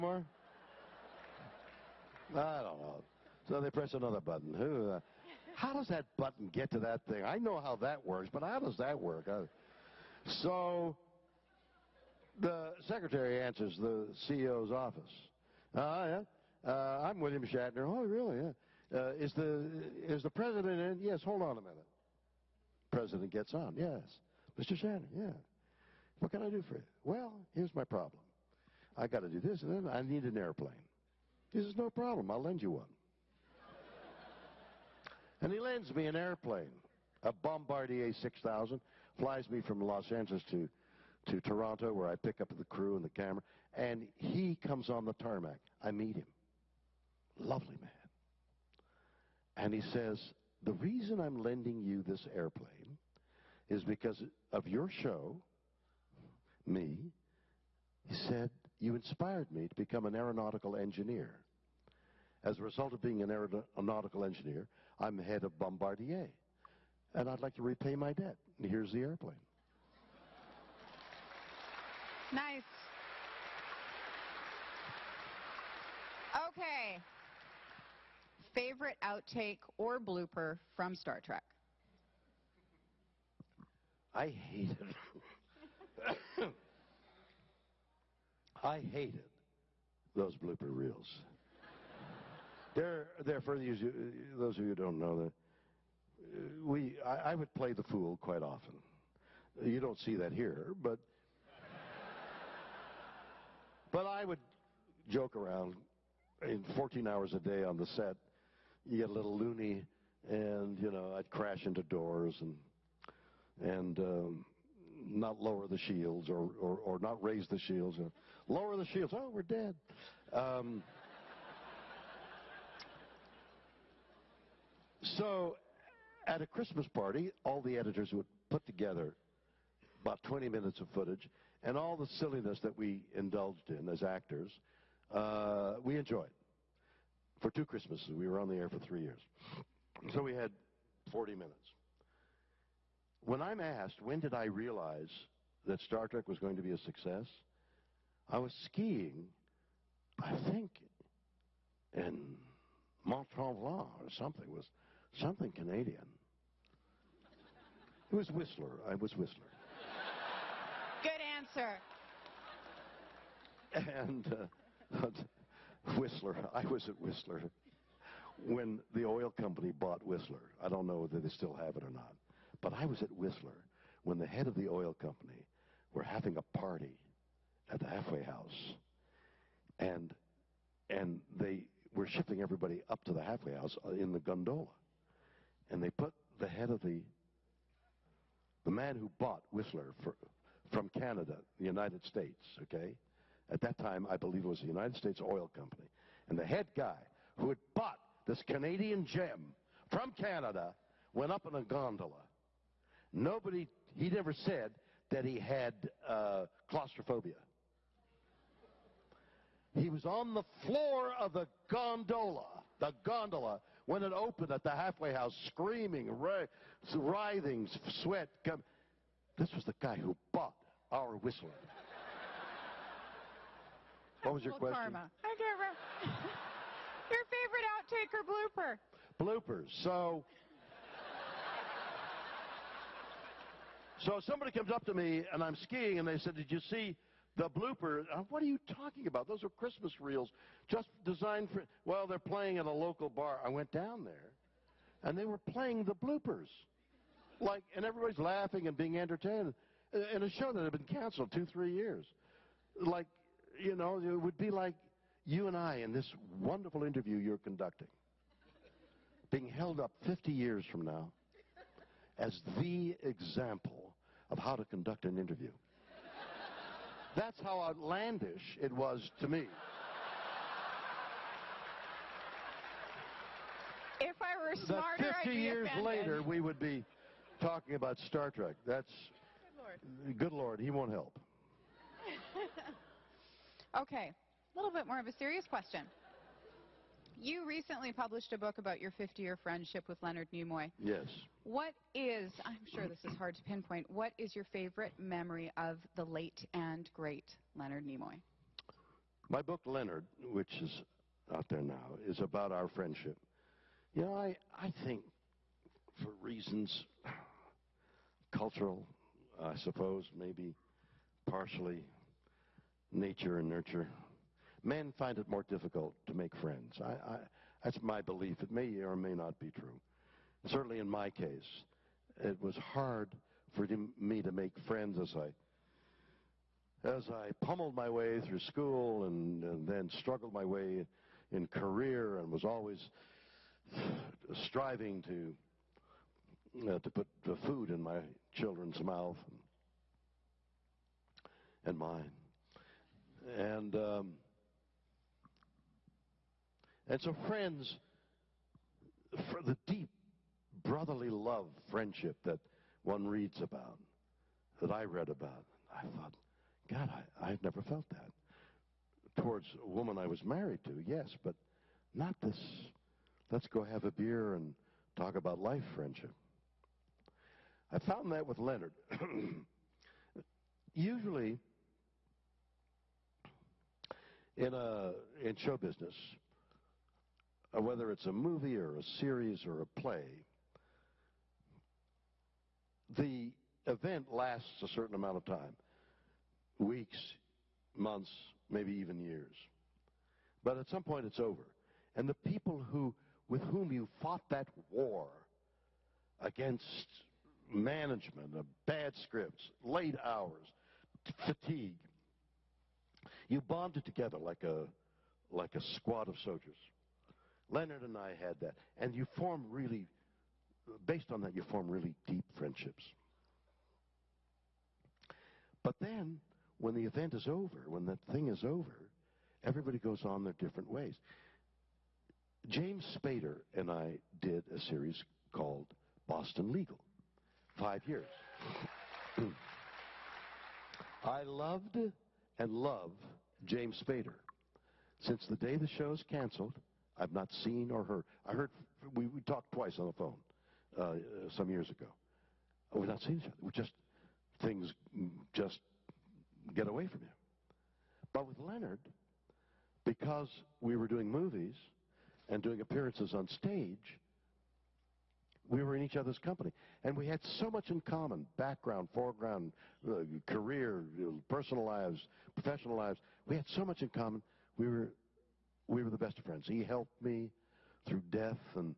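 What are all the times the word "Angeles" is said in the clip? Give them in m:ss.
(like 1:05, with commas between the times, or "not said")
0:40.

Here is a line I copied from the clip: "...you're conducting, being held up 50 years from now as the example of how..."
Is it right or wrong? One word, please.
right.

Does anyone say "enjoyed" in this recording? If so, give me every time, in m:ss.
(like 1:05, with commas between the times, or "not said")
2:15.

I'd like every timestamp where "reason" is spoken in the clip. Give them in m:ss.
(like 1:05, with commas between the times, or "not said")
0:50, 5:06.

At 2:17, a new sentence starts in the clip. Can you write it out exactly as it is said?
For two Christmases, we were on the air for three years.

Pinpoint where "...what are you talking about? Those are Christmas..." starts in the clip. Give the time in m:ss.
3:58.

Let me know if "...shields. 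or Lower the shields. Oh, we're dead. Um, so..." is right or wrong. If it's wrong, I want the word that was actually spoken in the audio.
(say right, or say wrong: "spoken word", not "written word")
right.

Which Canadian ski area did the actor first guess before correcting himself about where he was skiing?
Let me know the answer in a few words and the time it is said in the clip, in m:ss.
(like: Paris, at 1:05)
Mont Tremblant, at 2:33.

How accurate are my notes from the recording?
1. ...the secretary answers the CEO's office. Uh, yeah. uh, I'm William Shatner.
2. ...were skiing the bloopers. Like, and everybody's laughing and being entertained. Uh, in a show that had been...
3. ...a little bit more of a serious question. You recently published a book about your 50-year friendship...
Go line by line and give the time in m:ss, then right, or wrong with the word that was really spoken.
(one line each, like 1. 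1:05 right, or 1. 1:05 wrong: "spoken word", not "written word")
1. 0:12 right
2. 4:05 wrong: "playing", not "skiing"
3. 4:44 right.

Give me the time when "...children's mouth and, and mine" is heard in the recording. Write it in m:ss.
5:38.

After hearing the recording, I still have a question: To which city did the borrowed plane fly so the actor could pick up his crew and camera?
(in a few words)
Toronto.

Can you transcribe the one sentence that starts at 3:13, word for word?
At that time, I believe it was the United States Oil Company.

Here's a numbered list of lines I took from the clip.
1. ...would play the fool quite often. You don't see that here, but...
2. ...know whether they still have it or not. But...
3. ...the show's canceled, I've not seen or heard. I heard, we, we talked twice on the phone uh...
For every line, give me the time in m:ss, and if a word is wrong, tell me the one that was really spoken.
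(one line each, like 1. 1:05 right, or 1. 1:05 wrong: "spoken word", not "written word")
1. 1:37 right
2. 2:50 right
3. 7:15 right.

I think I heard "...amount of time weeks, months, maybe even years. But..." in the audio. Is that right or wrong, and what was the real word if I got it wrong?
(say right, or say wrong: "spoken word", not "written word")
right.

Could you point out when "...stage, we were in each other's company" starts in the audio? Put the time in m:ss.
7:33.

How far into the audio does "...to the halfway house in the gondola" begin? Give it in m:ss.
3:03.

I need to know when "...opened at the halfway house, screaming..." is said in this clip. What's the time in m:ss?
3:34.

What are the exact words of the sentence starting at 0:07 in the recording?
I know how that works, but how does that work?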